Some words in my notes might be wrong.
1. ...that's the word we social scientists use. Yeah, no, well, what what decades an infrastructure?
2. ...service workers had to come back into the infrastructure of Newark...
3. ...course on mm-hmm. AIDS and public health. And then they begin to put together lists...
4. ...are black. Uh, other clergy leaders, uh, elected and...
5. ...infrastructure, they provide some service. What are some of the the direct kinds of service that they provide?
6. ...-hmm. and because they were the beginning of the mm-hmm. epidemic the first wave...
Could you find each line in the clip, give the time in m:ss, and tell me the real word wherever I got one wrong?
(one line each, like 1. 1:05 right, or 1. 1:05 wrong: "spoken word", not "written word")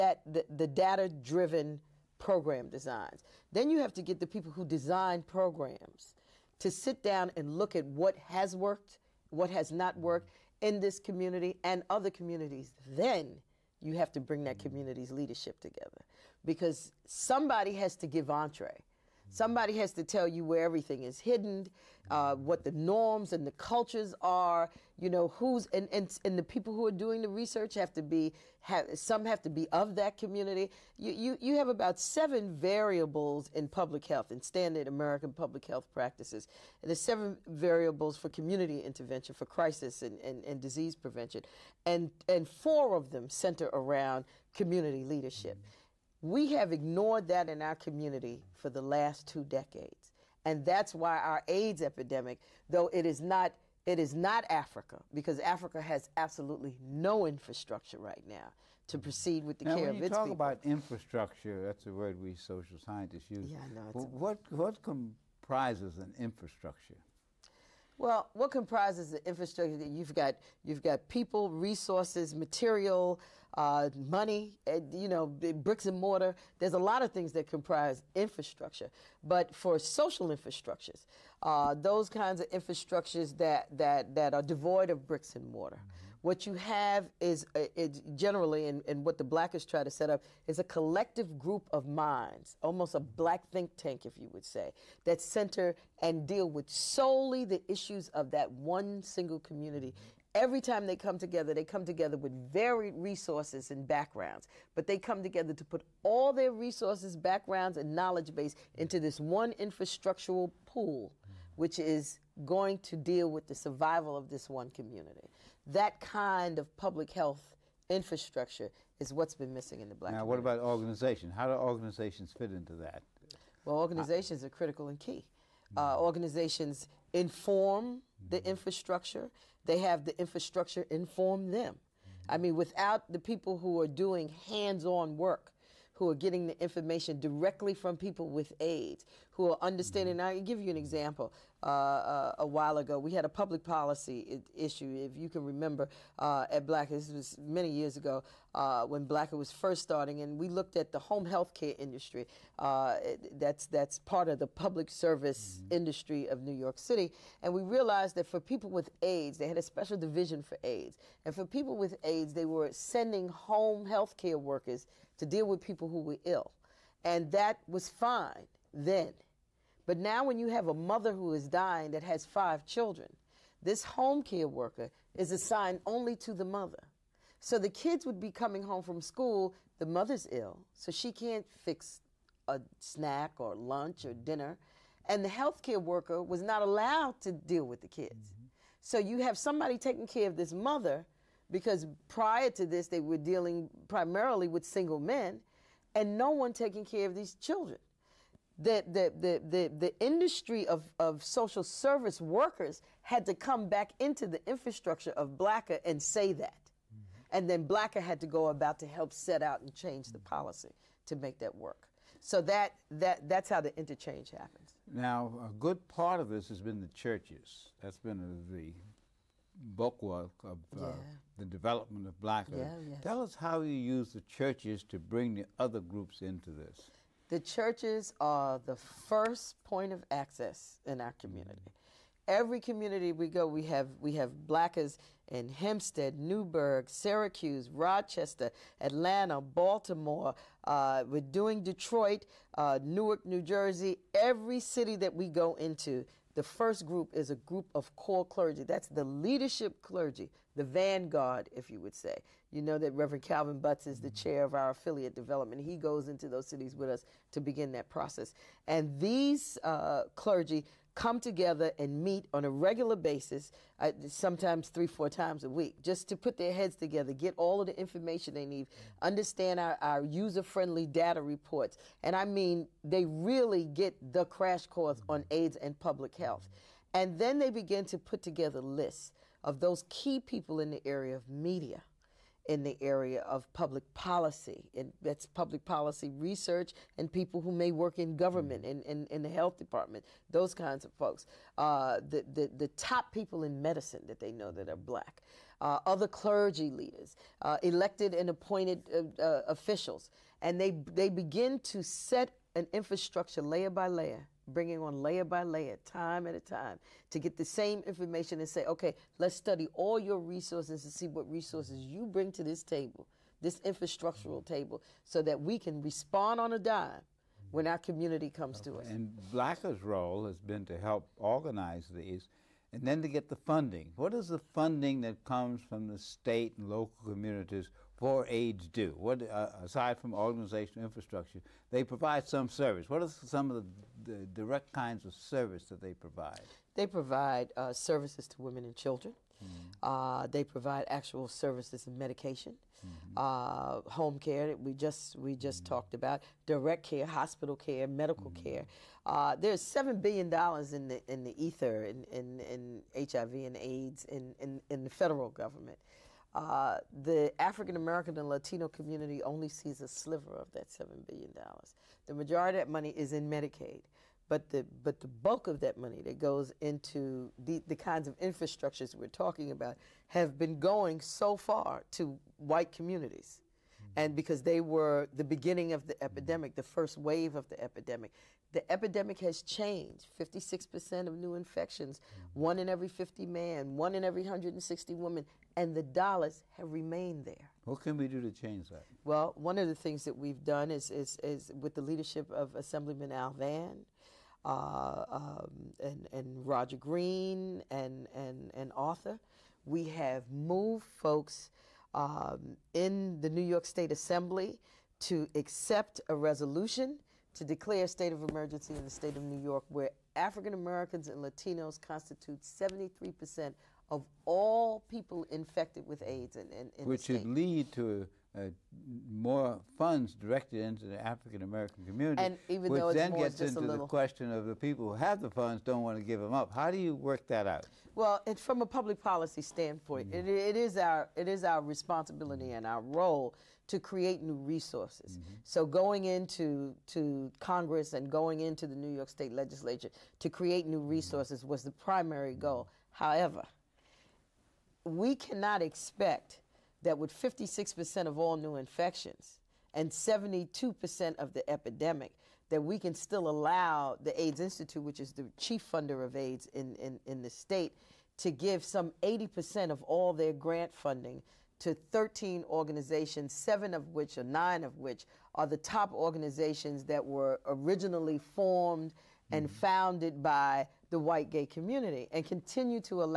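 1. 1:01 wrong: "comprises", not "decades"
2. 3:21 wrong: "BLCA", not "Newark"
3. 4:34 right
4. 4:54 right
5. 5:30 right
6. 6:13 right.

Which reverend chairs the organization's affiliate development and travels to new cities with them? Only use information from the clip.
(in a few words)
Calvin Butts.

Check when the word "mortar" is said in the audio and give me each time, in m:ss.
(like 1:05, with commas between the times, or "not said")
1:15, 1:25.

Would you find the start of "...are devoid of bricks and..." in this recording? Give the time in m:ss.
1:24.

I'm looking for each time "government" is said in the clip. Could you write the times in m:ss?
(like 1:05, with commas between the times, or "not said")
4:48, 5:55.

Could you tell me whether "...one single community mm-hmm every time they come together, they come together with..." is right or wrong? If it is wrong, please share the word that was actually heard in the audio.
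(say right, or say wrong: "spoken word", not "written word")
right.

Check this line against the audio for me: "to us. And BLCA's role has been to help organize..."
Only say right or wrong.
right.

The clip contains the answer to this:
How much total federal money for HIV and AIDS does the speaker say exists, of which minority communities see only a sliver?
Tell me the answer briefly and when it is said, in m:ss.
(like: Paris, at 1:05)
$7 billion, at 5:49.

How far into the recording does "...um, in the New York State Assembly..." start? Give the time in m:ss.
6:41.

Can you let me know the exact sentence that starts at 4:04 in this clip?
Every city that we go into, the first group is a group of core clergy.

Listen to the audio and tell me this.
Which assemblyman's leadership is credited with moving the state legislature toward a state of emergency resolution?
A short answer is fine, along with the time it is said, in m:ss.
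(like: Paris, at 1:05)
Al Vann, at 6:33.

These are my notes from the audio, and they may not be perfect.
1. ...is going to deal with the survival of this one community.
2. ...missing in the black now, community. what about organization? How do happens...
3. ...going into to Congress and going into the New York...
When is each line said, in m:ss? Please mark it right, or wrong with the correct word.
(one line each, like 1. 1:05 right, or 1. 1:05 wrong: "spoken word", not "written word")
1. 1:51 right
2. 1:59 wrong: "organizations", not "happens"
3. 7:15 right.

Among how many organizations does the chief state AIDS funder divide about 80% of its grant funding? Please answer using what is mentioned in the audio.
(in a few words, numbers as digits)
13.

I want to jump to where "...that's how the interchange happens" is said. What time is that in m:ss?
3:33.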